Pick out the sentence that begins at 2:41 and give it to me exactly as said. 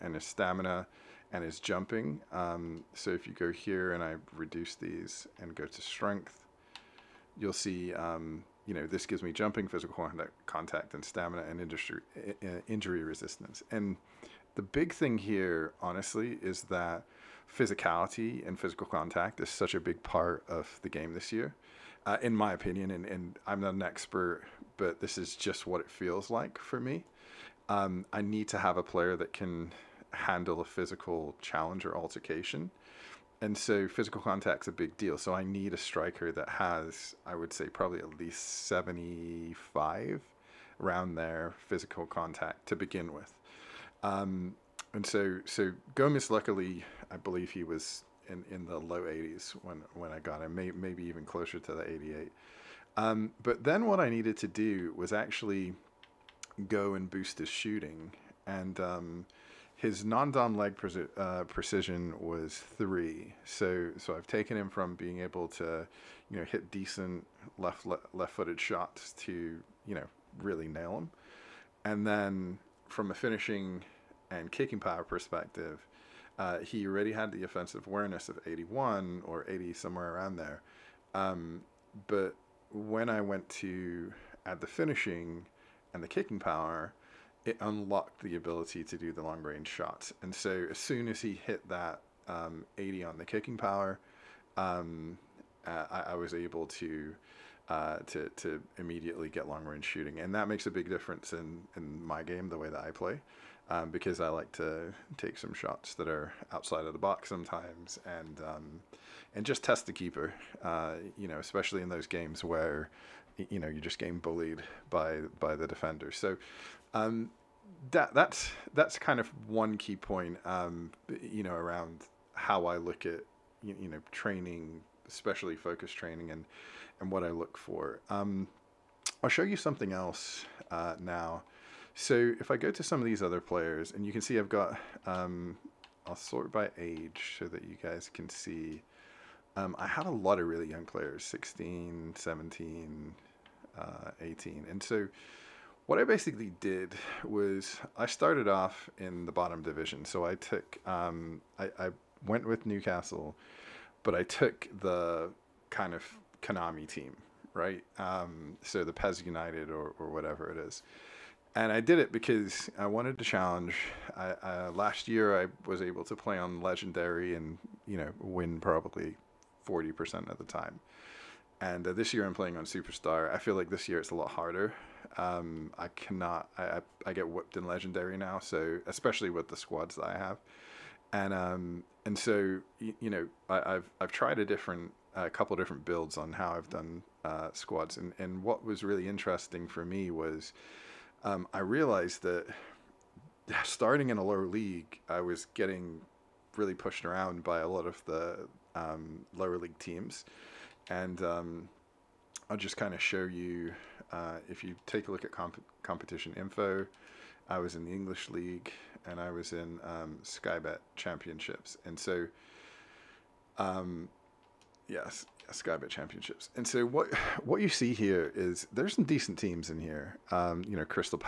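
And I did it because I wanted to challenge.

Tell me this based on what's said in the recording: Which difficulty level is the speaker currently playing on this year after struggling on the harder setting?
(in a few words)
Superstar.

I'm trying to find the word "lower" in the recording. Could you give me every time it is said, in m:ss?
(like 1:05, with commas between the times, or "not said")
3:14, 3:19.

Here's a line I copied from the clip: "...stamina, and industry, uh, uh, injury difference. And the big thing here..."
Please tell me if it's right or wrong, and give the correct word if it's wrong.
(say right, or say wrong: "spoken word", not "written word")
wrong: "resistance", not "difference".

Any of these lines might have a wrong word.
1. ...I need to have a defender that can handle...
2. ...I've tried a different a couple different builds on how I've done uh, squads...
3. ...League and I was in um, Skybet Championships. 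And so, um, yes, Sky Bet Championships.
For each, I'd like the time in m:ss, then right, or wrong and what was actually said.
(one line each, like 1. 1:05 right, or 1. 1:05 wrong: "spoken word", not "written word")
1. 0:28 wrong: "player", not "defender"
2. 3:04 right
3. 3:28 right.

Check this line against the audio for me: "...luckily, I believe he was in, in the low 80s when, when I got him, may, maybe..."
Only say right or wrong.
right.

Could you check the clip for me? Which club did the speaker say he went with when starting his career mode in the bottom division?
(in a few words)
Newcastle.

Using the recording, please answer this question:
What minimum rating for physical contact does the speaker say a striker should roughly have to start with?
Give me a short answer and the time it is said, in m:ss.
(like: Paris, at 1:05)
75, at 0:38.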